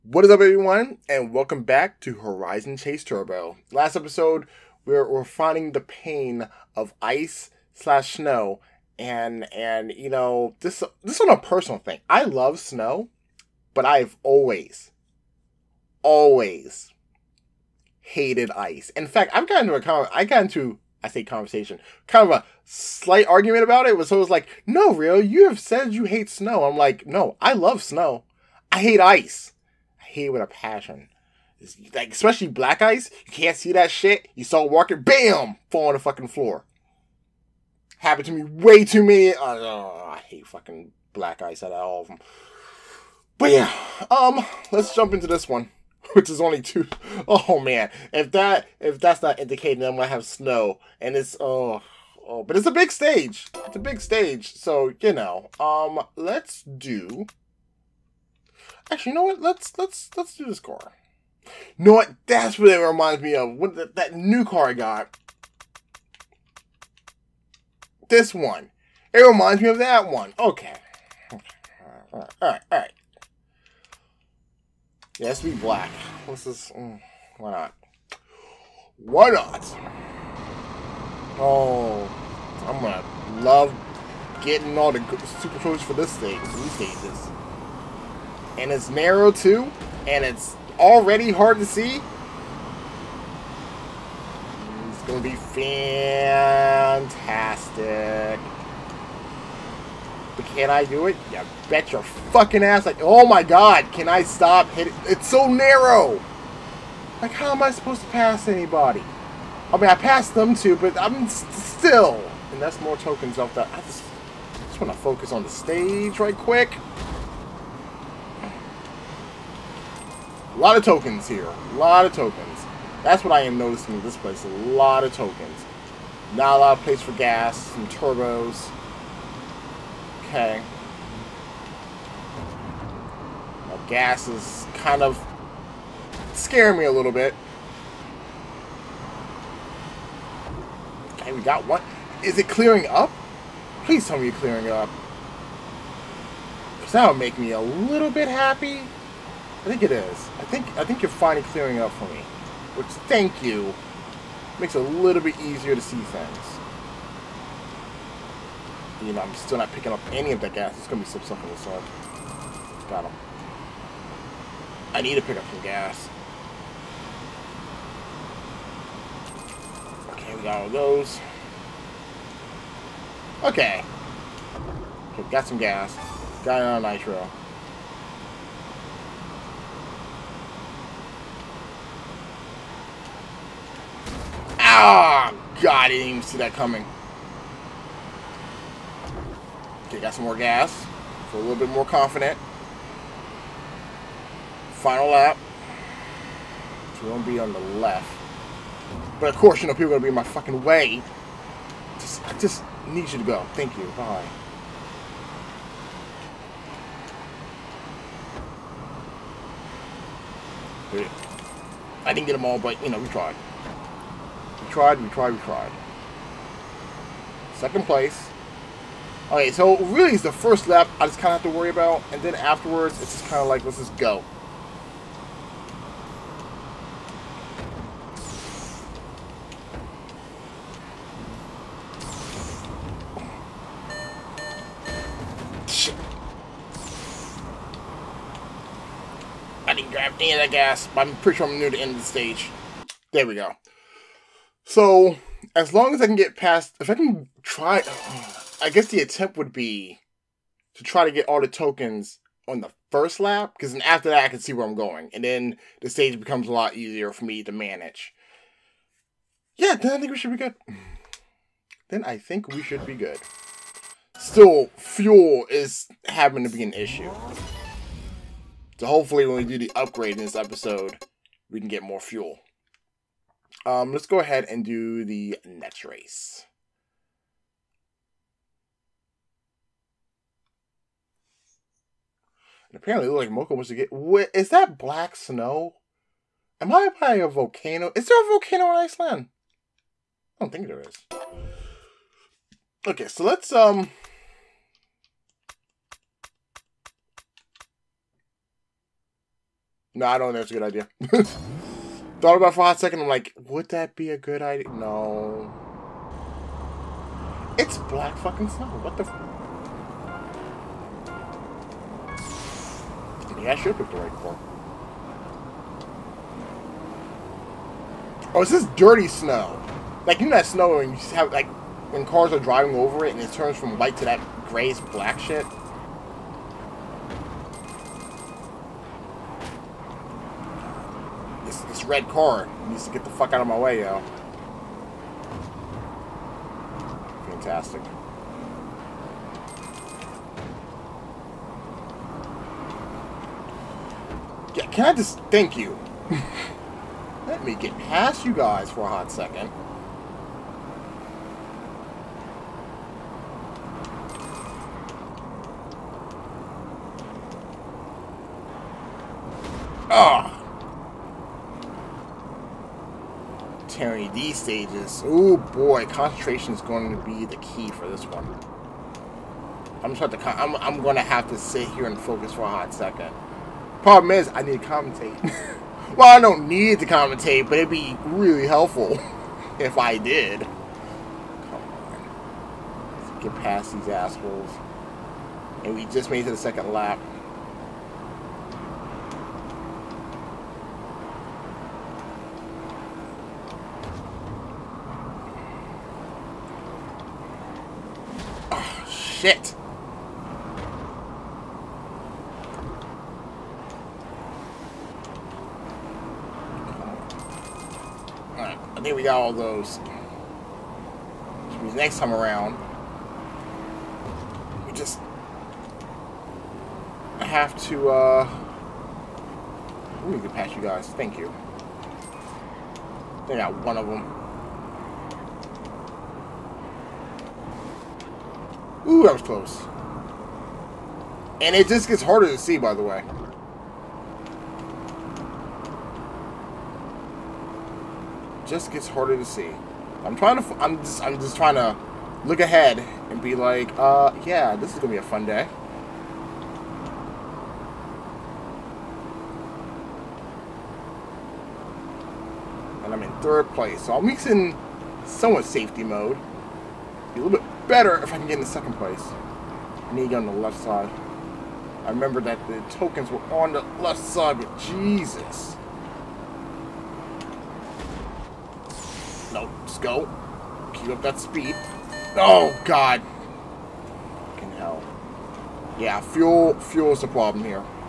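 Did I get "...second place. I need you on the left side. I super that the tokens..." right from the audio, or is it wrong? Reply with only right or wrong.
wrong.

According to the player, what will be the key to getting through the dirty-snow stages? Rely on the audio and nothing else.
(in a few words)
Concentration.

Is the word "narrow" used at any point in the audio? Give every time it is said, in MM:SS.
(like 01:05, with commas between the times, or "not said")
01:28, 01:45.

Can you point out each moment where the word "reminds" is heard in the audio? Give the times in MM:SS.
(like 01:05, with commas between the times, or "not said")
01:02, 01:09.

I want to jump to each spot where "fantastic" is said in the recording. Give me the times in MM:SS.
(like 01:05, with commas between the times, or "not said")
01:35, 05:37.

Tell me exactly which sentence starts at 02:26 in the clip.
Because that would make me a little bit happy.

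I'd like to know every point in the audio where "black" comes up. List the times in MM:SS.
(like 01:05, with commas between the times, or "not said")
00:32, 00:41, 01:15, 04:44, 05:07, 05:24.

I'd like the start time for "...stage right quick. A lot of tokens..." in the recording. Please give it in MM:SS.
01:55.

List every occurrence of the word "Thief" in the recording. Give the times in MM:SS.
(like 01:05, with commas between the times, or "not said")
not said.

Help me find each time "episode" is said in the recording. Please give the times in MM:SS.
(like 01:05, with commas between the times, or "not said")
00:03, 04:30.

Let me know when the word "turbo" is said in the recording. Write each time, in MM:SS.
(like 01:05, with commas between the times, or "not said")
00:03, 02:07.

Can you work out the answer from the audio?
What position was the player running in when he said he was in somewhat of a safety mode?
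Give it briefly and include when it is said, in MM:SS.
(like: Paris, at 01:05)
Third place, at 07:33.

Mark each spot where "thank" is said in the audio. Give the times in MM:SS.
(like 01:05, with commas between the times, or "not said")
02:33, 03:23, 05:45, 07:00.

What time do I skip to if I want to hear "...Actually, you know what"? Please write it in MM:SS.
00:58.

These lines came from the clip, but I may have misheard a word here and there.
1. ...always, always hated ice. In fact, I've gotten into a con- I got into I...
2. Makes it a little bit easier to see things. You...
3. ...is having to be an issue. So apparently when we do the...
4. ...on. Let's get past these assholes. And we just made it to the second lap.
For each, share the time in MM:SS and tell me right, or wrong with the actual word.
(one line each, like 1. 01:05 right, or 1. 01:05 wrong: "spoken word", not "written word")
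1. 00:14 right
2. 02:34 right
3. 04:25 wrong: "hopefully", not "apparently"
4. 06:21 right.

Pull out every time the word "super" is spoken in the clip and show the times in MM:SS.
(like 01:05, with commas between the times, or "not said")
01:25.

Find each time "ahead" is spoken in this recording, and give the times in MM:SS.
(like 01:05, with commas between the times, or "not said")
04:34, 07:22.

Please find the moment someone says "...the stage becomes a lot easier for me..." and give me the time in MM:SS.
04:15.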